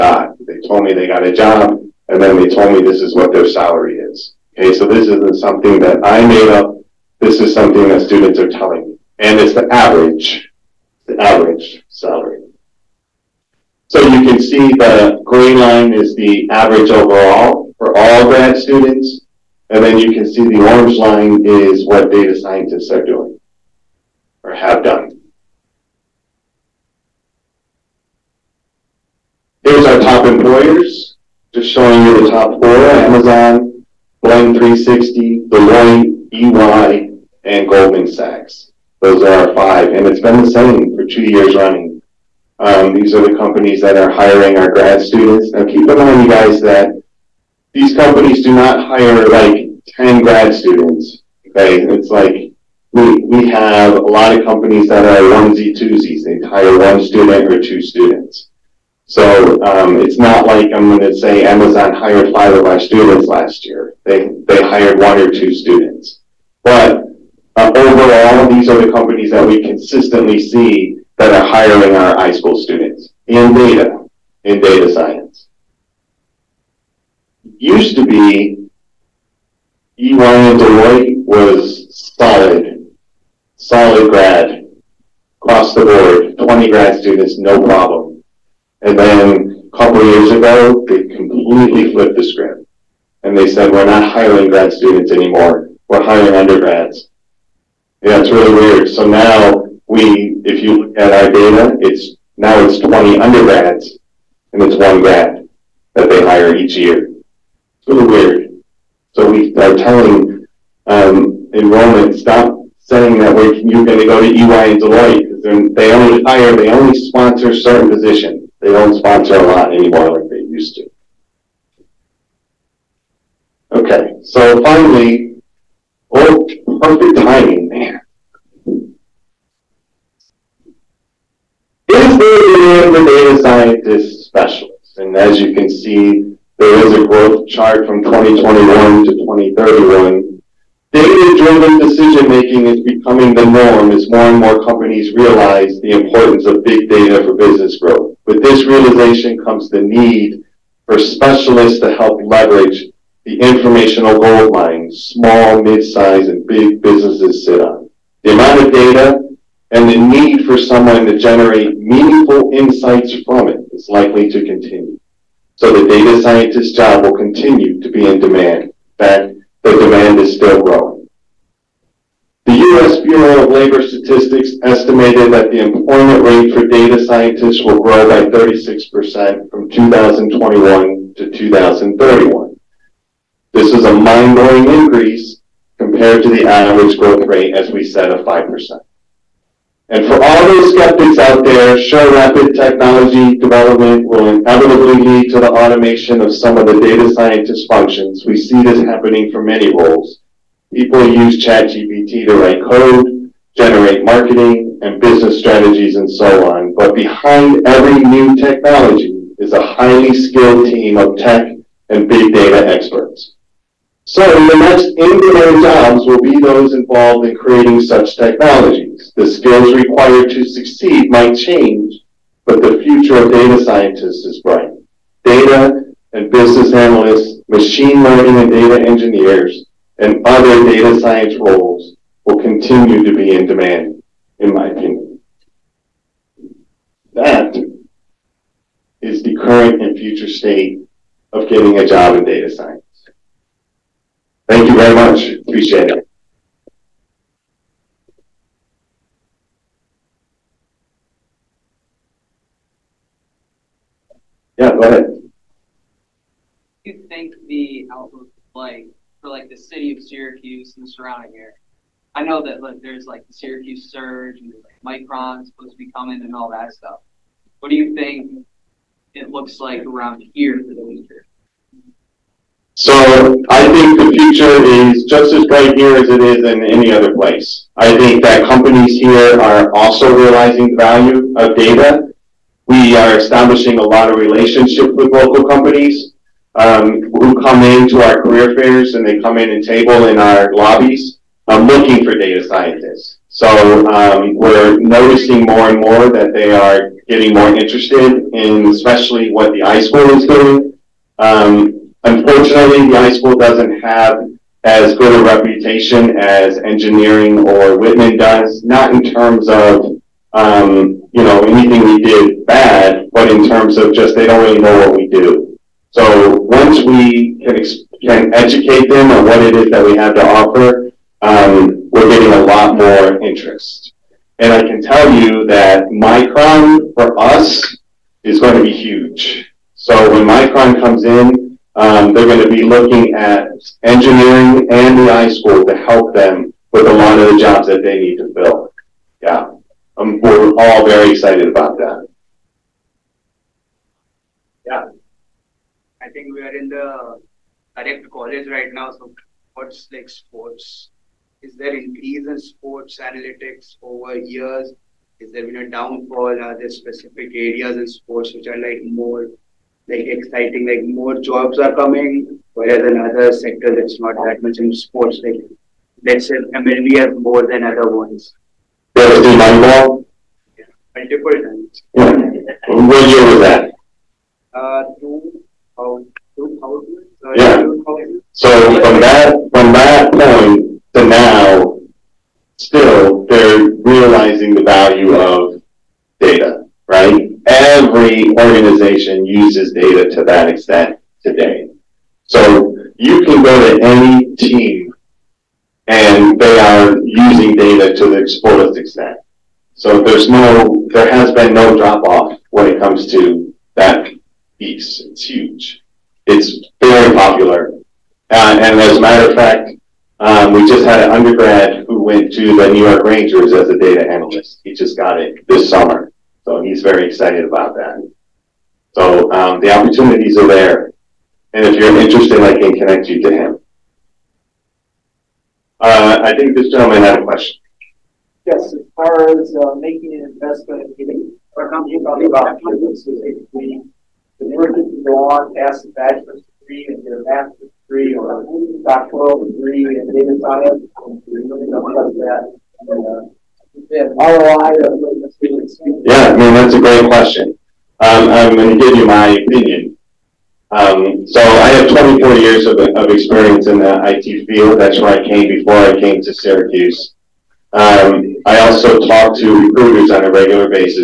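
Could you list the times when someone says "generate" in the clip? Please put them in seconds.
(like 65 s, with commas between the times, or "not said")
161 s, 203 s.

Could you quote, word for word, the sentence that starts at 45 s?
Now keep in mind, you guys, that these companies do not hire like 10 grad students.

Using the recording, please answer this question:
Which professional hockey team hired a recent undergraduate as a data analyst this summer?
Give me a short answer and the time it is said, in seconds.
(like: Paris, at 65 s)
New York Rangers, at 412 s.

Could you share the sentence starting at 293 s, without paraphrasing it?
So um, we're noticing more and more that they are getting more interested in especially what the iSchool is doing.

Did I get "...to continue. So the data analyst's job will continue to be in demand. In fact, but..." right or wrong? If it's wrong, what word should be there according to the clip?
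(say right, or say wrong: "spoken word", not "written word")
wrong: "scientist", not "analyst".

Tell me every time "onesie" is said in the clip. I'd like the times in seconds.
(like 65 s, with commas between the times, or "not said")
55 s.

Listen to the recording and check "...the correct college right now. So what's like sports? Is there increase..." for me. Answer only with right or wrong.
right.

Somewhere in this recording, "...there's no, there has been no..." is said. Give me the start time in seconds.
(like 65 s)
400 s.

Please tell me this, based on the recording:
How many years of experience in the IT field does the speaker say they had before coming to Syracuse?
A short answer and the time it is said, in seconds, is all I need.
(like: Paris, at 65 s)
24, at 451 s.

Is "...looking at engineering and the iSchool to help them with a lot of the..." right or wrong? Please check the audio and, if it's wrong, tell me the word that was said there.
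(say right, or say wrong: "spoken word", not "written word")
right.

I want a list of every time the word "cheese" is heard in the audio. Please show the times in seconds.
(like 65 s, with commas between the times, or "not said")
not said.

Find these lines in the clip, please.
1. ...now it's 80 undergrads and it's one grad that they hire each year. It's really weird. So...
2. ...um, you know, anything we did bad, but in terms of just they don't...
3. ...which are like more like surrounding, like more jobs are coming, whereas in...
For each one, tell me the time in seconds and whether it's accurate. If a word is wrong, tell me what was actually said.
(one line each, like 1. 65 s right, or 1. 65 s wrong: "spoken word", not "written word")
1. 102 s wrong: "20", not "80"
2. 310 s right
3. 358 s wrong: "exciting", not "surrounding".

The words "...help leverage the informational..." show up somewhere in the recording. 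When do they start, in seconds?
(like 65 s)
151 s.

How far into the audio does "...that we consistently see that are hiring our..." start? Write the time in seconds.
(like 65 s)
69 s.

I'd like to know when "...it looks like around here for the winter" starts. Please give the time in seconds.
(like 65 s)
269 s.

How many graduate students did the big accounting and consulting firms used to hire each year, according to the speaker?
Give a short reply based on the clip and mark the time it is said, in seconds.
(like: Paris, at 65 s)
20, at 86 s.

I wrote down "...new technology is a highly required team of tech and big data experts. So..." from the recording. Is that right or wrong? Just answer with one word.
wrong.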